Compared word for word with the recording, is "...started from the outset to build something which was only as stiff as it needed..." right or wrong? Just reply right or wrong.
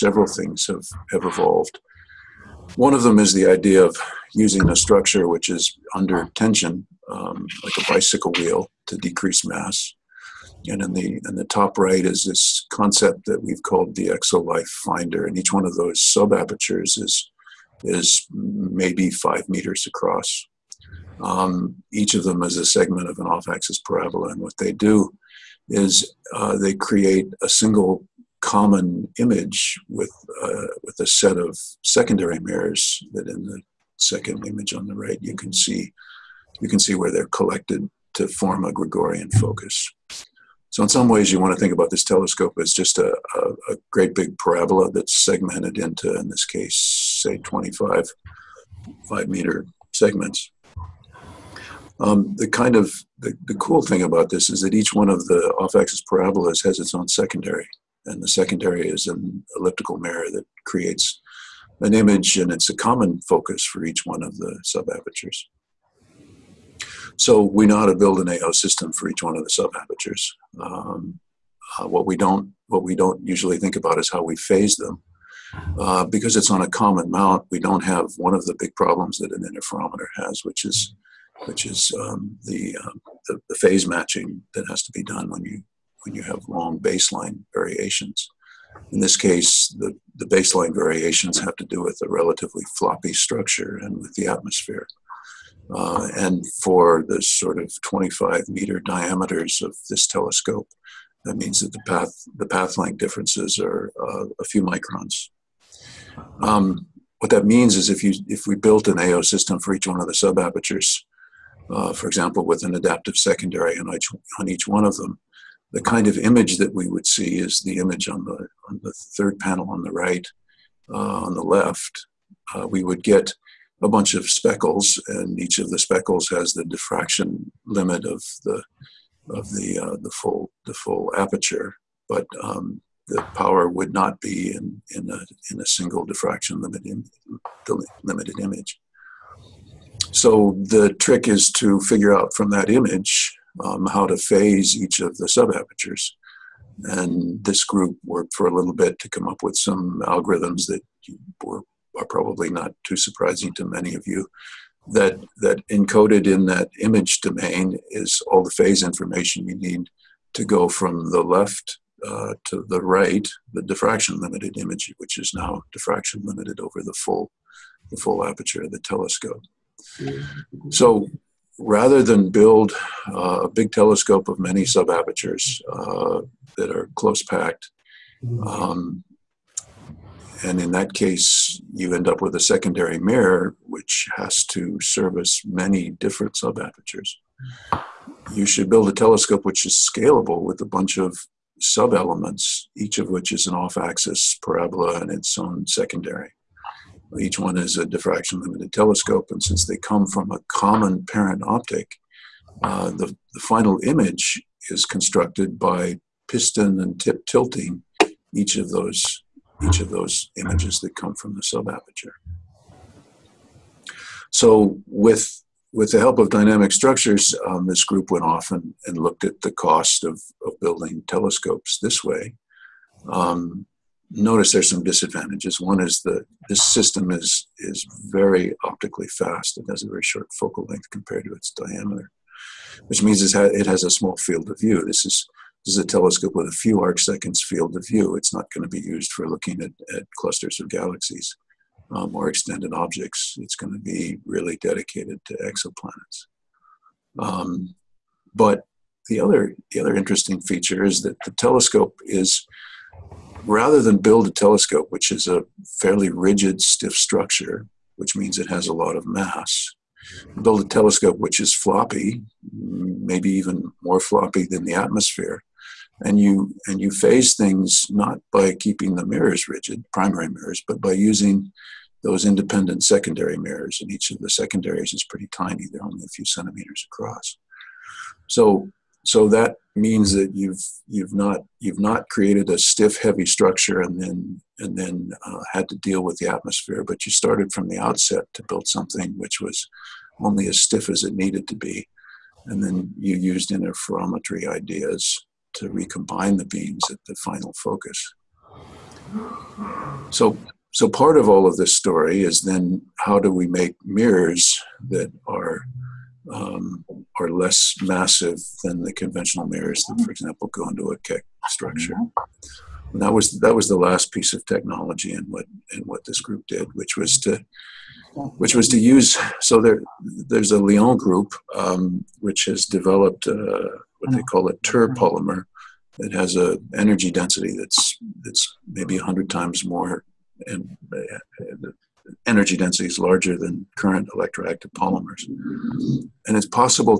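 right.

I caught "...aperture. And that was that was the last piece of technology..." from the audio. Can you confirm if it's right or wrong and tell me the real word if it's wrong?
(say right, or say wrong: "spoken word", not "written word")
wrong: "structure", not "aperture".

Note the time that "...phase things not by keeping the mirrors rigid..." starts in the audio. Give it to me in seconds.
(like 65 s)
266 s.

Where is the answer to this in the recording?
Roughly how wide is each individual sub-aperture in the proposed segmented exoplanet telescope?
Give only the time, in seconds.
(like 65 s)
19 s.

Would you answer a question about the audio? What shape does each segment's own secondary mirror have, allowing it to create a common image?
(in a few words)
elliptical.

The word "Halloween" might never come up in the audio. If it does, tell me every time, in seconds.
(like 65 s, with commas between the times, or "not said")
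not said.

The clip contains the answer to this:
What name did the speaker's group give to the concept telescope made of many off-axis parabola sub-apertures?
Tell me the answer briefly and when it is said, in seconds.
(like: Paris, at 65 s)
exolife finder, at 14 s.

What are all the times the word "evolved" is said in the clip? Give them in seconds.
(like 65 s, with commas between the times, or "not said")
1 s.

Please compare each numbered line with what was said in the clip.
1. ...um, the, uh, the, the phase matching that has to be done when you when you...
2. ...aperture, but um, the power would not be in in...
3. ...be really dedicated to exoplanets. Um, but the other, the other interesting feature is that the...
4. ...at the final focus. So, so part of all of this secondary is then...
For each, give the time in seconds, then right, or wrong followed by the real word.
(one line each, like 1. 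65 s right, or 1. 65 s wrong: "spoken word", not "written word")
1. 81 s right
2. 131 s right
3. 243 s right
4. 296 s wrong: "story", not "secondary".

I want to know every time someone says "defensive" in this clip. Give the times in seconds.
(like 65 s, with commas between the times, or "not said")
not said.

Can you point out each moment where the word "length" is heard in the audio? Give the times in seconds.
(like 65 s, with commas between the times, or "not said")
102 s, 230 s.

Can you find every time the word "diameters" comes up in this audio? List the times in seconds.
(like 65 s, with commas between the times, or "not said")
98 s, 231 s.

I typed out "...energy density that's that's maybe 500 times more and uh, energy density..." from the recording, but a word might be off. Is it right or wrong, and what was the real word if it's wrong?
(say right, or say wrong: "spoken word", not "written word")
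wrong: "100", not "500".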